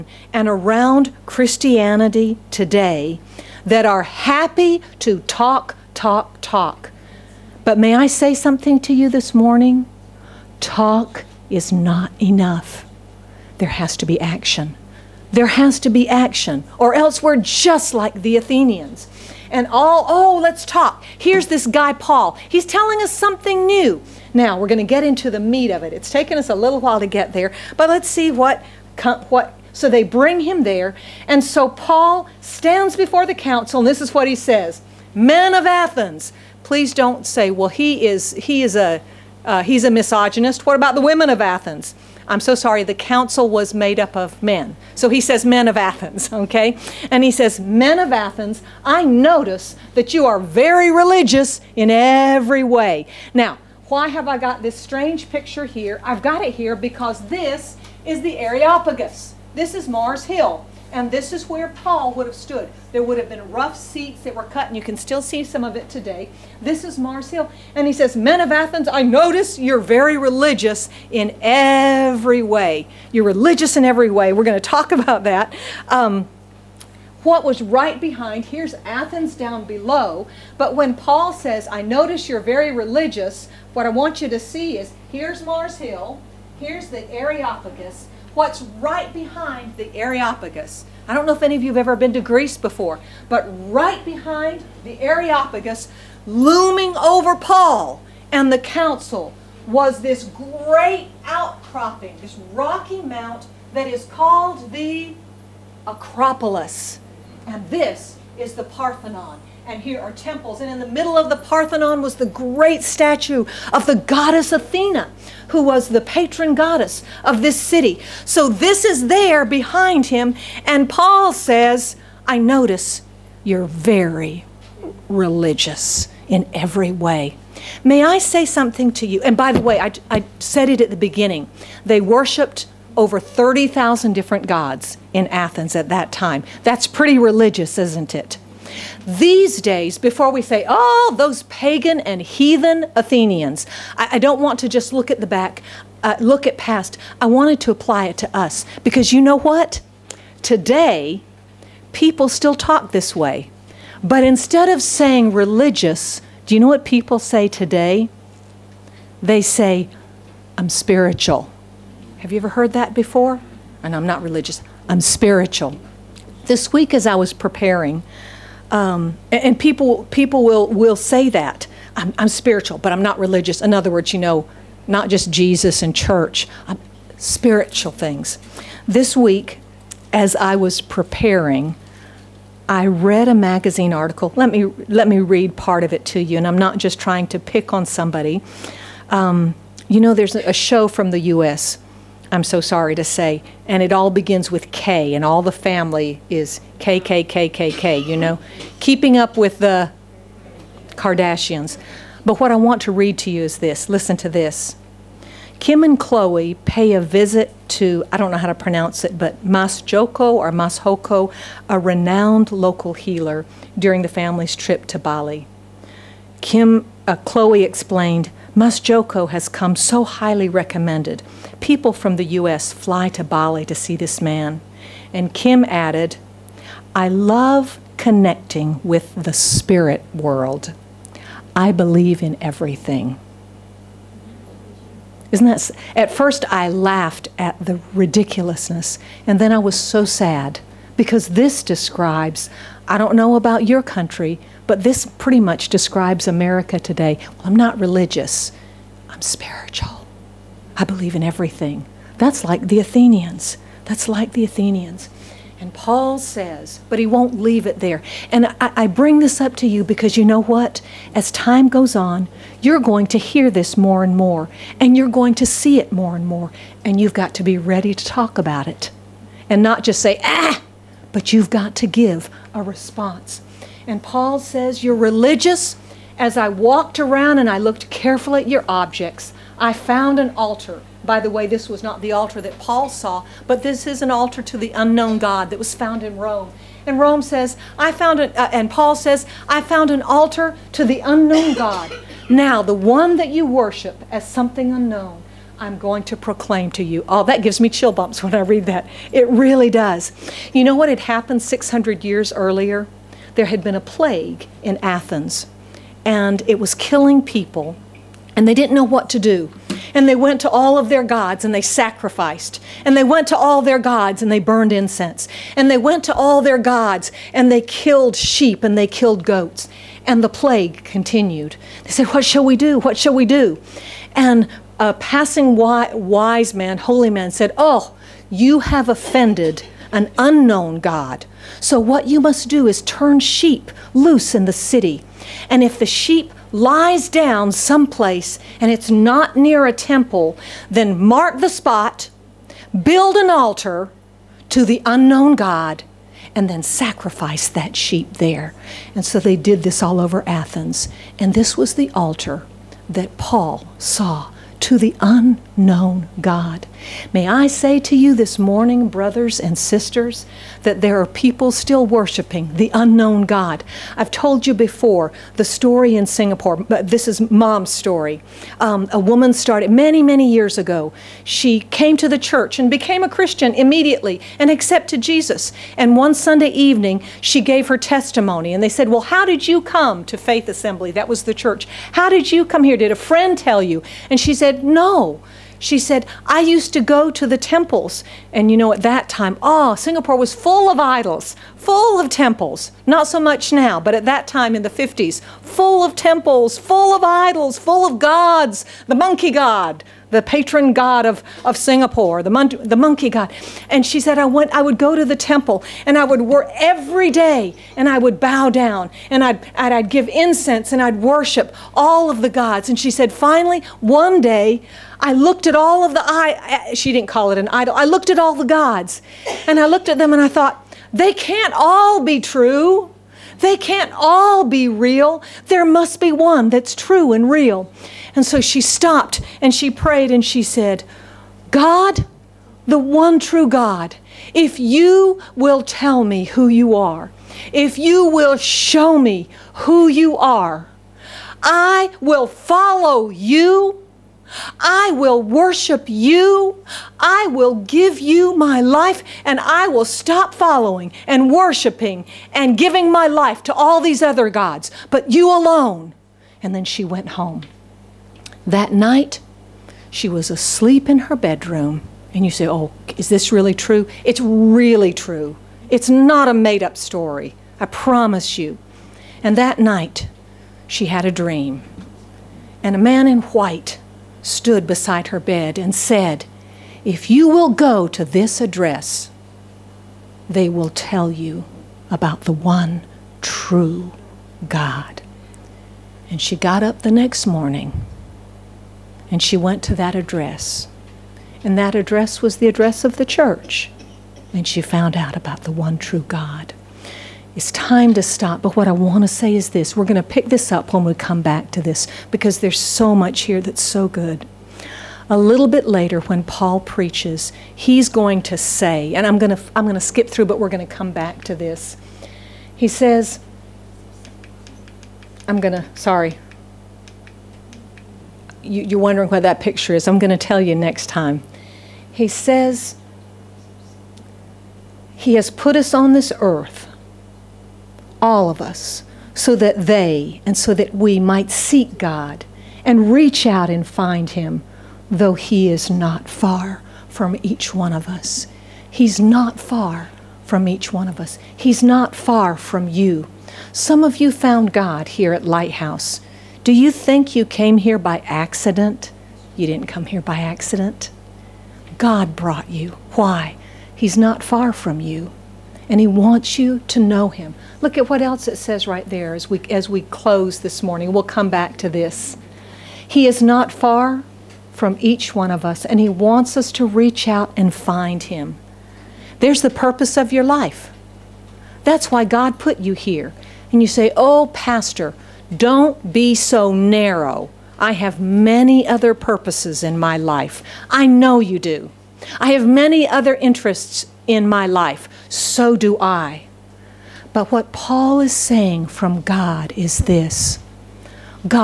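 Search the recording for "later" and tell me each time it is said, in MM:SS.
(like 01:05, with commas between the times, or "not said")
08:25.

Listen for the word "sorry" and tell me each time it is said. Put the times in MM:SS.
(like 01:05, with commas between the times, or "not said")
00:42, 03:12, 08:35.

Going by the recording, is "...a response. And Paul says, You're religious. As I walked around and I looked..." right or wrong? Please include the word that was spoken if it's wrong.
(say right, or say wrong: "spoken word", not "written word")
right.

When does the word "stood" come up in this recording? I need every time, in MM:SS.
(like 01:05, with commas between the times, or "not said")
01:02, 07:54.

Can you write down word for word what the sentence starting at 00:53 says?
Now, why have I got this strange picture here?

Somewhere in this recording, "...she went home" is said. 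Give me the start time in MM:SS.
07:36.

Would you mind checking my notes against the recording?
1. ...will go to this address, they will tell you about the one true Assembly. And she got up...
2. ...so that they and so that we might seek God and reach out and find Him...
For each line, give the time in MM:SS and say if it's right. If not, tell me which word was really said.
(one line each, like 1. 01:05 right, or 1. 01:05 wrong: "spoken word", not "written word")
1. 07:57 wrong: "God", not "Assembly"
2. 08:49 right.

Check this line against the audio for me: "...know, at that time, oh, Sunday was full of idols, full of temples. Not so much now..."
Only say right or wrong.
wrong.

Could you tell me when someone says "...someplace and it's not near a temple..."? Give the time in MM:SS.
05:37.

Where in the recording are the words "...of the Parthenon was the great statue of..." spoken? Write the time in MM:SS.
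01:51.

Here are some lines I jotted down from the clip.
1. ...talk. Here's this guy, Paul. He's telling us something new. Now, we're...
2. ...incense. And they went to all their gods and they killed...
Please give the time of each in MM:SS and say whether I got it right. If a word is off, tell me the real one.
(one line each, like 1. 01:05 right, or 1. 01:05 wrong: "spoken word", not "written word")
1. 00:20 right
2. 05:14 right.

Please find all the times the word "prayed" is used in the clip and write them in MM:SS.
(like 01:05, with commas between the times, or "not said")
07:09.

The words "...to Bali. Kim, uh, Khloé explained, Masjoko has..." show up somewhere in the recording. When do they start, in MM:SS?
03:34.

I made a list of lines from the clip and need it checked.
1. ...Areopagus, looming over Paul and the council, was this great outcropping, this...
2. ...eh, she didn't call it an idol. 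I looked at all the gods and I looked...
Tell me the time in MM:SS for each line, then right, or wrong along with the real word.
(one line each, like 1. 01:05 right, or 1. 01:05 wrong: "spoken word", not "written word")
1. 01:35 right
2. 06:56 right.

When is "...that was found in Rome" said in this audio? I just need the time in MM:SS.
04:45.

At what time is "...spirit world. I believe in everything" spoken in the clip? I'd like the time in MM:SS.
03:49.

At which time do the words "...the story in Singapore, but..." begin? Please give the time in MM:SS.
06:05.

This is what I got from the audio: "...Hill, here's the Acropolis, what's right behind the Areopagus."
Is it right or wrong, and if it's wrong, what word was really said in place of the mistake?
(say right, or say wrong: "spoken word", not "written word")
wrong: "Areopagus", not "Acropolis".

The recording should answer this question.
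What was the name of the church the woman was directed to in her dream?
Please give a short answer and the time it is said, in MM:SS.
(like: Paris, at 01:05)
Faith Assembly, at 06:20.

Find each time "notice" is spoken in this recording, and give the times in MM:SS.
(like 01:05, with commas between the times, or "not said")
00:49, 01:09, 01:21, 02:02.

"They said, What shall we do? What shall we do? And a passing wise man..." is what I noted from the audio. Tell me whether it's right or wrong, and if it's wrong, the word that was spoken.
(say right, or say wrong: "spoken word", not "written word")
right.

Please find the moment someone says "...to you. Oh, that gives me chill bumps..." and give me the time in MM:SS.
04:56.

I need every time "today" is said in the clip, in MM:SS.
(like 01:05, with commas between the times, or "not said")
00:02, 01:05, 02:30, 02:37, 04:06.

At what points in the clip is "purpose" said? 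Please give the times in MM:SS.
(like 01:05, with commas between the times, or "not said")
09:29, 09:38.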